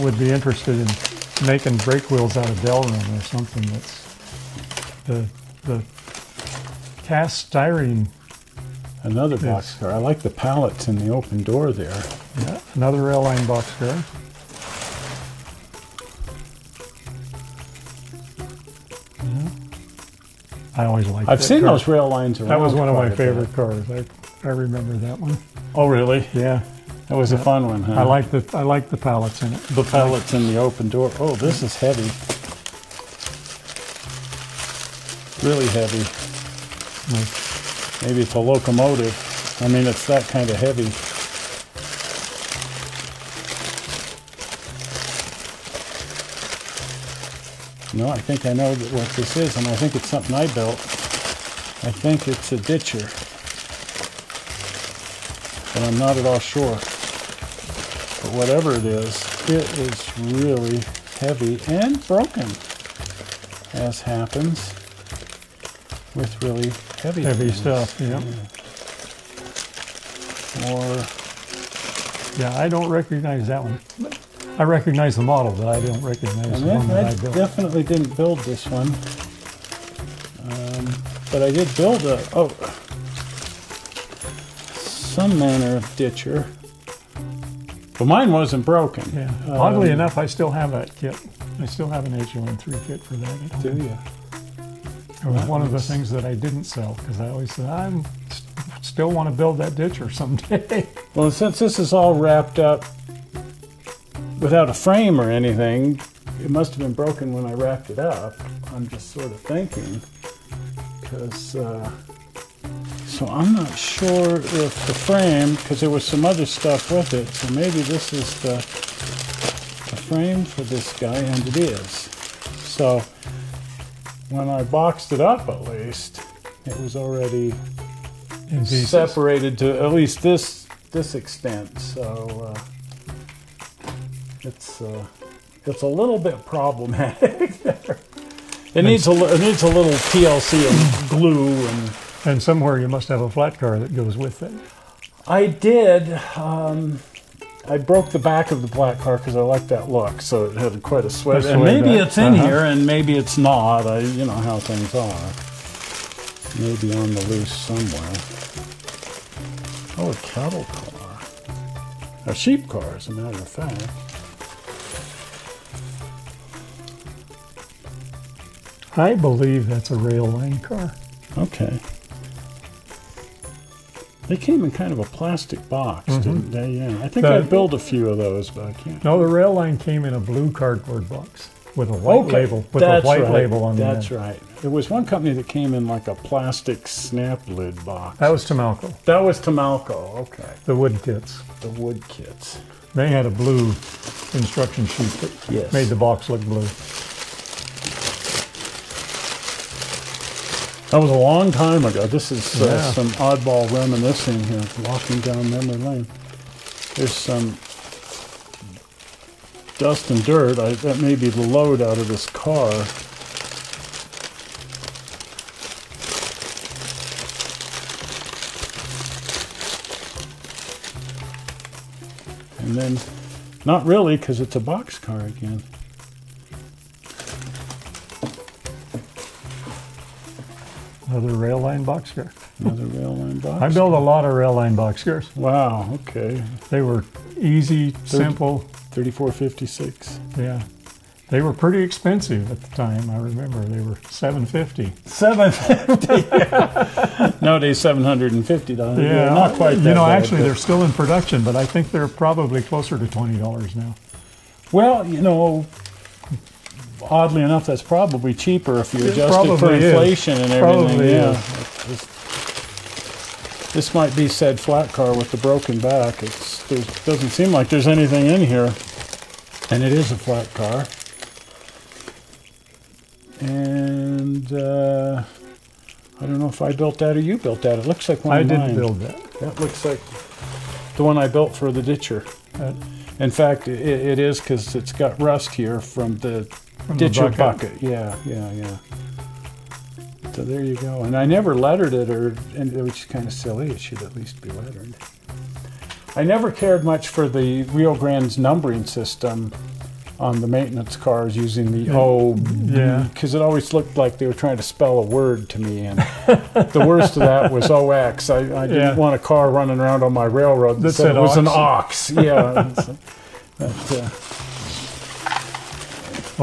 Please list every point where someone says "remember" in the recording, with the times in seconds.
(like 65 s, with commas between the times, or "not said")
24 s, 243 s.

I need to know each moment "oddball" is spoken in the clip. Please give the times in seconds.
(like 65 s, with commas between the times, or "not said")
203 s.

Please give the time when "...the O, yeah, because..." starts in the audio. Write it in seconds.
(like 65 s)
301 s.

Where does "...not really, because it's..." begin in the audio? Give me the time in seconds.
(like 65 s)
223 s.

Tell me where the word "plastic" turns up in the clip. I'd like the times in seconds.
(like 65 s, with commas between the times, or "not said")
175 s, 186 s.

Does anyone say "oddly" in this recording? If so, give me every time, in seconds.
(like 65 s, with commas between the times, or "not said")
89 s, 257 s.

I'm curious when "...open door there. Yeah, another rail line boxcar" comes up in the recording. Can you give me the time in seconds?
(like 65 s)
11 s.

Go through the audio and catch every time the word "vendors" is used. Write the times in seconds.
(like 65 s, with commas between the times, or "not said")
not said.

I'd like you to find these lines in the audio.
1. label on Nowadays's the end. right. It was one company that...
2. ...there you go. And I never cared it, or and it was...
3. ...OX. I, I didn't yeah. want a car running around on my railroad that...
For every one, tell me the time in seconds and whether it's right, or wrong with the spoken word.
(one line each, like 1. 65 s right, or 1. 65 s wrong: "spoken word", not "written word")
1. 183 s wrong: "That", not "Nowadays"
2. 290 s wrong: "lettered", not "cared"
3. 307 s right.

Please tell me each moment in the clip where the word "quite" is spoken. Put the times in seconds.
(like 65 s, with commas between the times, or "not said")
150 s, 249 s.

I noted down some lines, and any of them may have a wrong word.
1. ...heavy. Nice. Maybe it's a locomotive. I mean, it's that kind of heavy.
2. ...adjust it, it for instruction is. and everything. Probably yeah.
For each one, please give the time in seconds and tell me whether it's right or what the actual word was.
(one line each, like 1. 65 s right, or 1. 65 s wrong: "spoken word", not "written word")
1. 35 s right
2. 259 s wrong: "inflation", not "instruction".